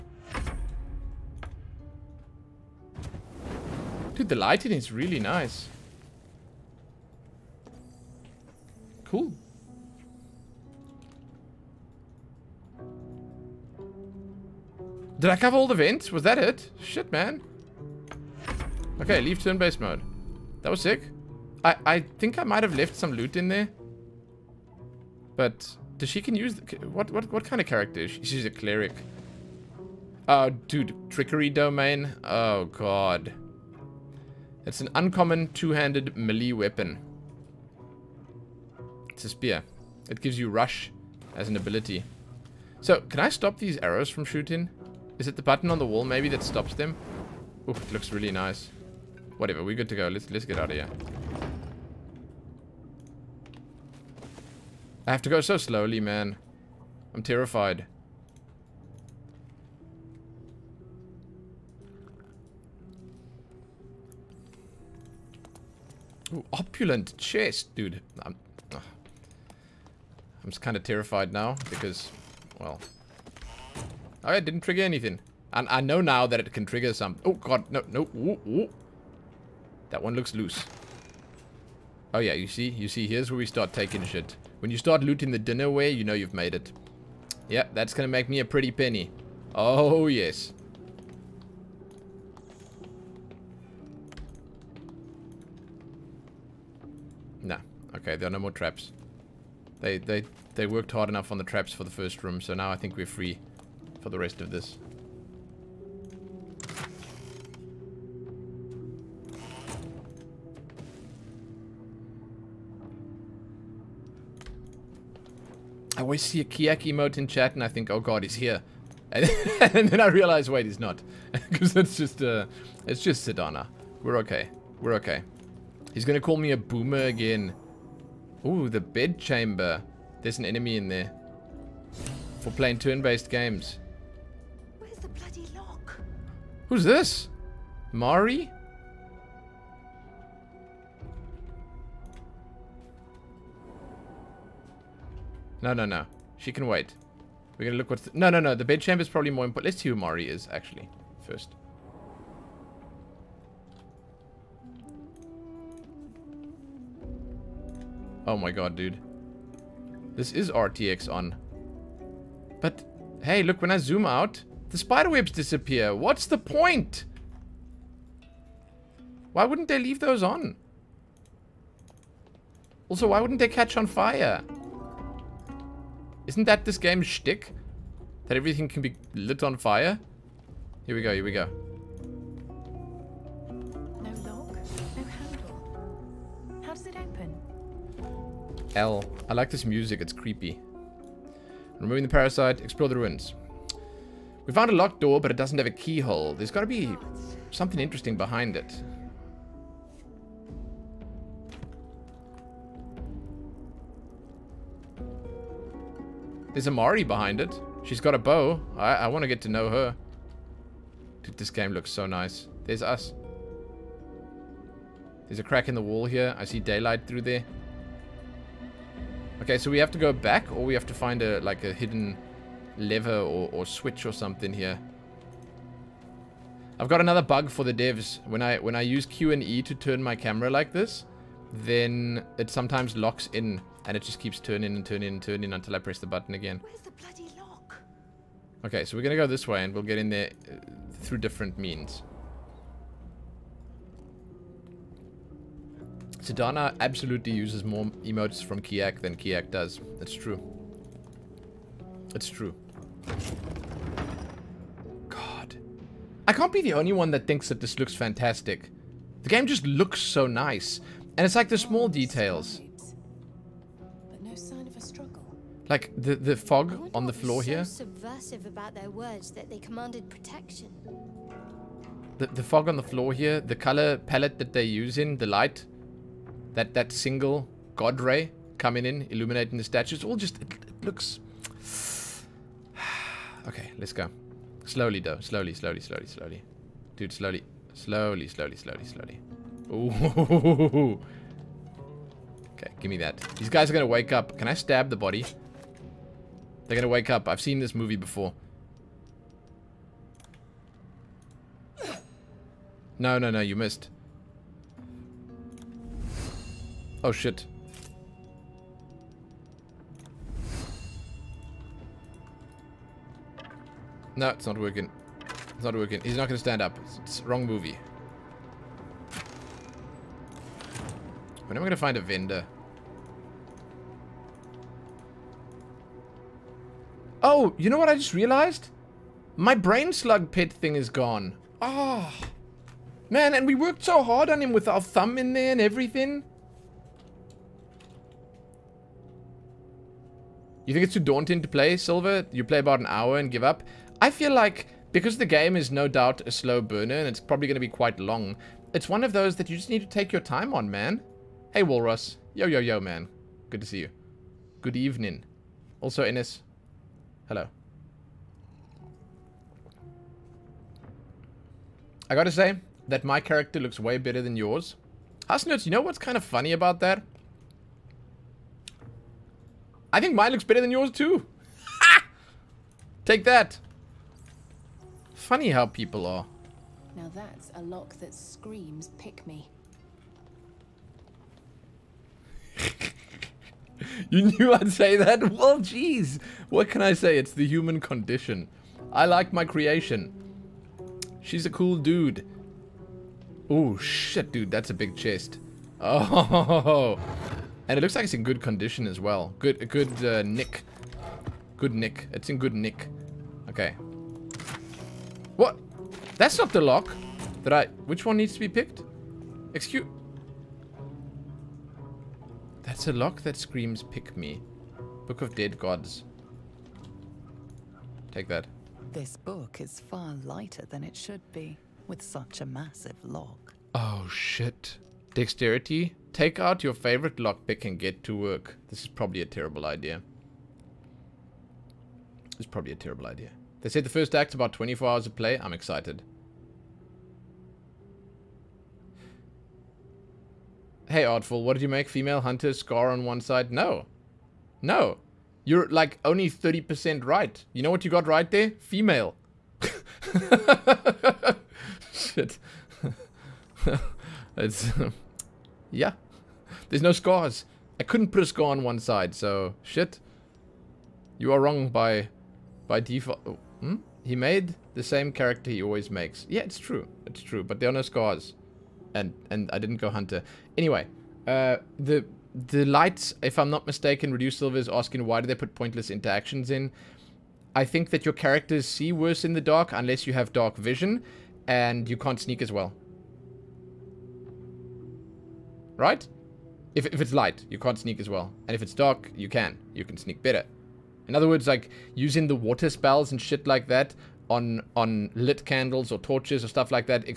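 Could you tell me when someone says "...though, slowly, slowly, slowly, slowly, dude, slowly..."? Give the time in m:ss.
4:45.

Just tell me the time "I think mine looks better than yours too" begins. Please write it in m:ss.
6:09.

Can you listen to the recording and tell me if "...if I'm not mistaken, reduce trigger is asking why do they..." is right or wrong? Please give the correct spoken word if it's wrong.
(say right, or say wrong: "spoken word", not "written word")
wrong: "silver", not "trigger".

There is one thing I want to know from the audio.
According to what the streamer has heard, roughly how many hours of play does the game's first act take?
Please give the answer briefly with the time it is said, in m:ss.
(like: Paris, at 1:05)
24 hours, at 7:14.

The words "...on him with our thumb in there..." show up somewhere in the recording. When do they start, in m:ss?
5:34.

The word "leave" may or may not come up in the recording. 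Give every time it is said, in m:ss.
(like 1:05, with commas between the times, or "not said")
0:19, 2:49.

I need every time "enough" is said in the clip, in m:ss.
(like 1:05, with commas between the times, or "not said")
1:41.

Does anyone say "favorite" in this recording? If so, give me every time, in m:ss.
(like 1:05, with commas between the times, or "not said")
7:06.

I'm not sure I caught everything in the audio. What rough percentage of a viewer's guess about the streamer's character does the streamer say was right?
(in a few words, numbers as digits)
30%.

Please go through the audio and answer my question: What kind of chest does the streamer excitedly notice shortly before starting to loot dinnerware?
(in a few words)
Opulent chest.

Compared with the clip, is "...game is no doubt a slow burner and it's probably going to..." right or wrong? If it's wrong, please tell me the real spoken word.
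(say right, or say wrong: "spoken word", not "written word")
right.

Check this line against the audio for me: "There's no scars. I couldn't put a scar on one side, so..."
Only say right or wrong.
right.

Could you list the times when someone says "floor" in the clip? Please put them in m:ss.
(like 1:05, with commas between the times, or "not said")
4:27, 4:32.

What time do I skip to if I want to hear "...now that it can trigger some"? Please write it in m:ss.
1:16.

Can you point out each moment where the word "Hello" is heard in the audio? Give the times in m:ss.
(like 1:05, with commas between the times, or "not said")
5:57.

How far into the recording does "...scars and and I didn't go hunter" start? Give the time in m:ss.
7:47.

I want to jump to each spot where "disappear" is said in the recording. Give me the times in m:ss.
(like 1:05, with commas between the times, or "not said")
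2:45.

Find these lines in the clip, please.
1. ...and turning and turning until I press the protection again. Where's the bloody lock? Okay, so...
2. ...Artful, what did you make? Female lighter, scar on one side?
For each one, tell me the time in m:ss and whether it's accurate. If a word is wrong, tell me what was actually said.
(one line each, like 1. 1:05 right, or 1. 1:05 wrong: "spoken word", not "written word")
1. 3:54 wrong: "button", not "protection"
2. 7:21 wrong: "hunter", not "lighter".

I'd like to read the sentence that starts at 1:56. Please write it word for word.
always see a Kiak emote in chat and I think, oh god, he's here.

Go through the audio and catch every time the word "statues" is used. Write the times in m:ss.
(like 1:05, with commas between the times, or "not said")
4:39.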